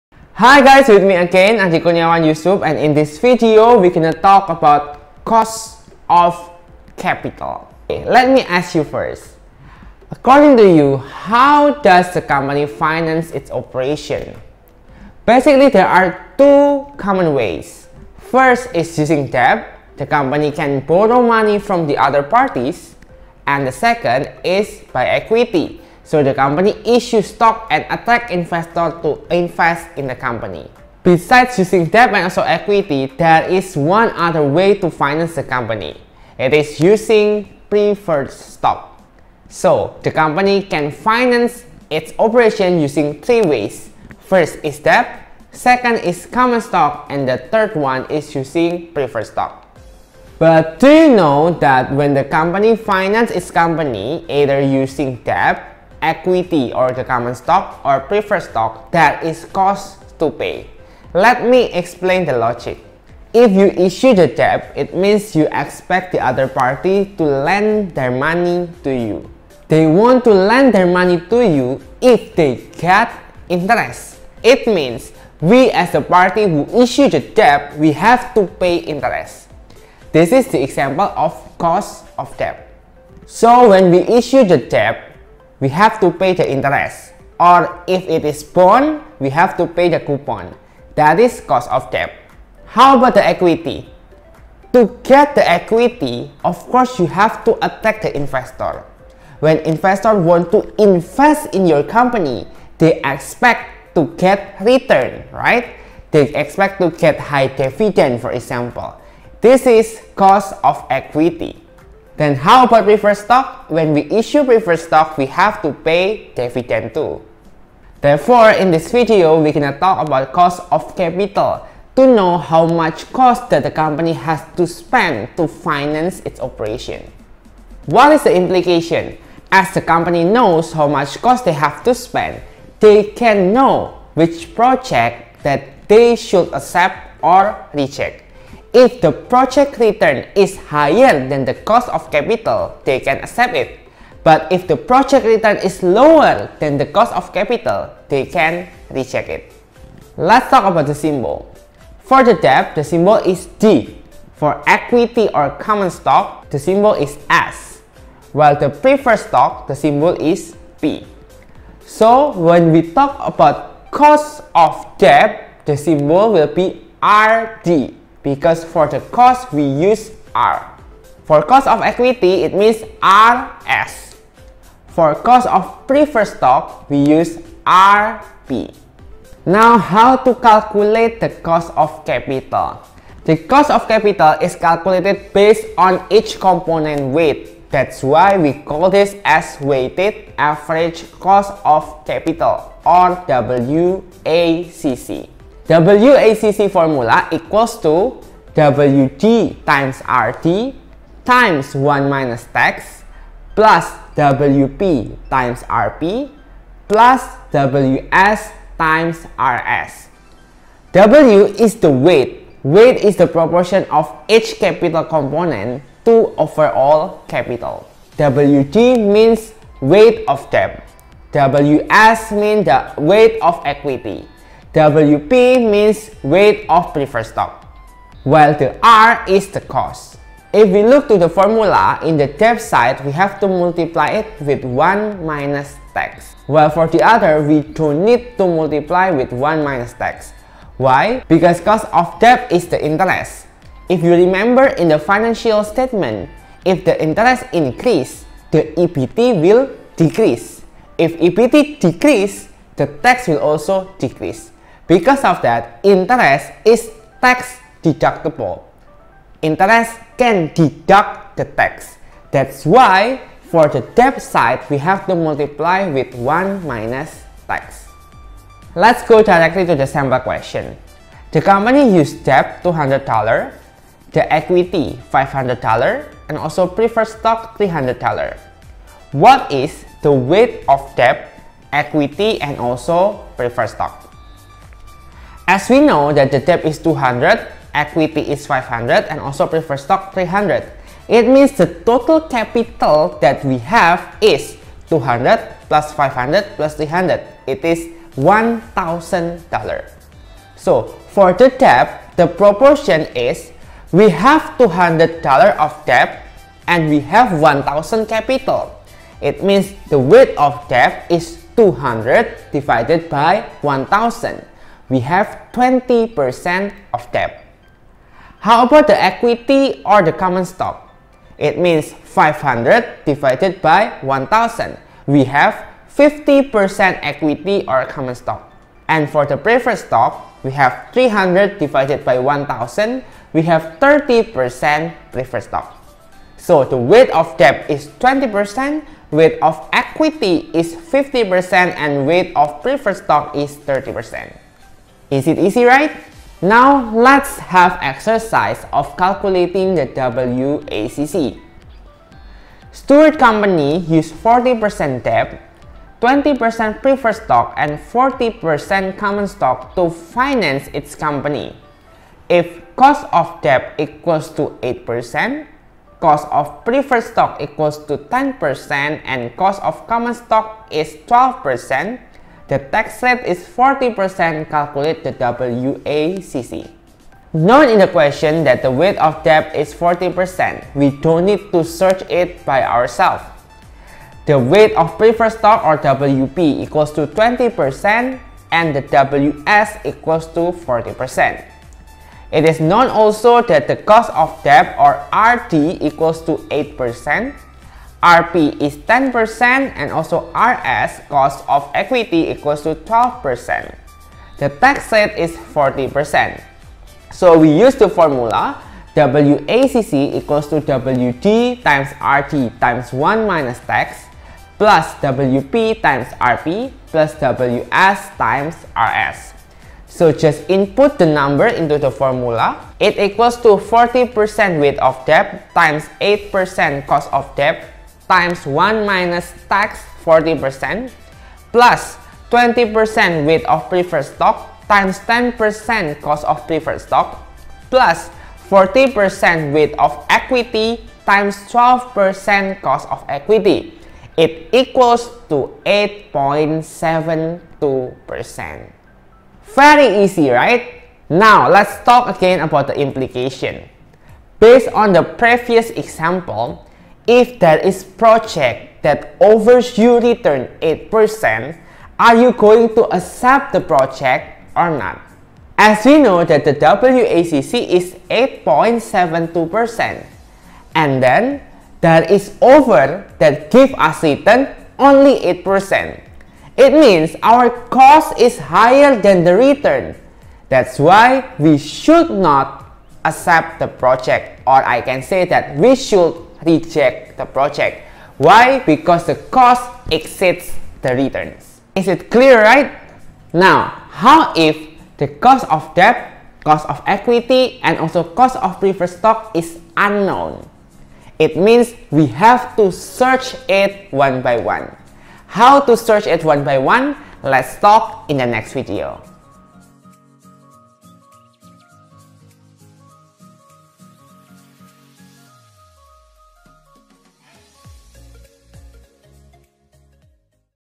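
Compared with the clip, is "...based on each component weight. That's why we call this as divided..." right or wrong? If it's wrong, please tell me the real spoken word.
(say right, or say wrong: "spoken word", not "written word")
wrong: "weighted", not "divided".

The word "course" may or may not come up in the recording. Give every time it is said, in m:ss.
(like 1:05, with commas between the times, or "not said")
1:36.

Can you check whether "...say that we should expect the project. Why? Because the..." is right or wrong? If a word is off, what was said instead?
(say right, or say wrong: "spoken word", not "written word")
wrong: "reject", not "expect".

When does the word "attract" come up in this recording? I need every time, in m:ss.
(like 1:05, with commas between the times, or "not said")
0:27, 1:37.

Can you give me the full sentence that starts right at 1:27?
Or if it is bond, we have to pay the coupon.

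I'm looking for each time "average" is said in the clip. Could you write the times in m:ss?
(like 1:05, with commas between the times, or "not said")
3:10.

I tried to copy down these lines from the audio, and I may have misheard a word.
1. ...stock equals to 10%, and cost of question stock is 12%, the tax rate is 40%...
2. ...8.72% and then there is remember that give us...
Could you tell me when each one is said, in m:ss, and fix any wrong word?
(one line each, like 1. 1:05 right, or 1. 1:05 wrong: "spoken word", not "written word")
1. 6:07 wrong: "common", not "question"
2. 7:48 wrong: "offer", not "remember".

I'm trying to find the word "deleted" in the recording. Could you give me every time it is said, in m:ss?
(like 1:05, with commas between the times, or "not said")
not said.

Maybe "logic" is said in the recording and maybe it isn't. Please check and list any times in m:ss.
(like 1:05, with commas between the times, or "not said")
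1:02.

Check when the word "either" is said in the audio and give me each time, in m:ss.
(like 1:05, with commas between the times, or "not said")
0:54.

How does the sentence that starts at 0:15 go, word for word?
Basically, there are two common ways.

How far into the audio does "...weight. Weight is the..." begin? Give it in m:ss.
3:31.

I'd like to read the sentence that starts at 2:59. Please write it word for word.
Now, how to calculate the cost of capital?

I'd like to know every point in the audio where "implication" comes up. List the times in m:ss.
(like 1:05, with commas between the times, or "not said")
2:08, 7:32.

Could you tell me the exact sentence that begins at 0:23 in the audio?
And the second is by equity.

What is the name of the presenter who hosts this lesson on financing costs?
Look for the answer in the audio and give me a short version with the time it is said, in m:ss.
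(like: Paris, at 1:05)
Adi Kurniawan Yusup, at 0:01.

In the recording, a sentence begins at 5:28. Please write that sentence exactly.
And for the preferred stock, we have 300 divided by 1000.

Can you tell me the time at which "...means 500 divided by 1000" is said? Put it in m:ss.
5:21.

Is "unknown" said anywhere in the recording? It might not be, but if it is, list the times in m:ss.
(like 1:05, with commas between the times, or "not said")
8:19.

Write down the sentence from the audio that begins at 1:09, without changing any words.
They want to lend their money to you if they get interest.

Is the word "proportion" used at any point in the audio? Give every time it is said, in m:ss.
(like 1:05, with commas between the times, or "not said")
3:33, 5:02.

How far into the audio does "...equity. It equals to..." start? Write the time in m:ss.
7:23.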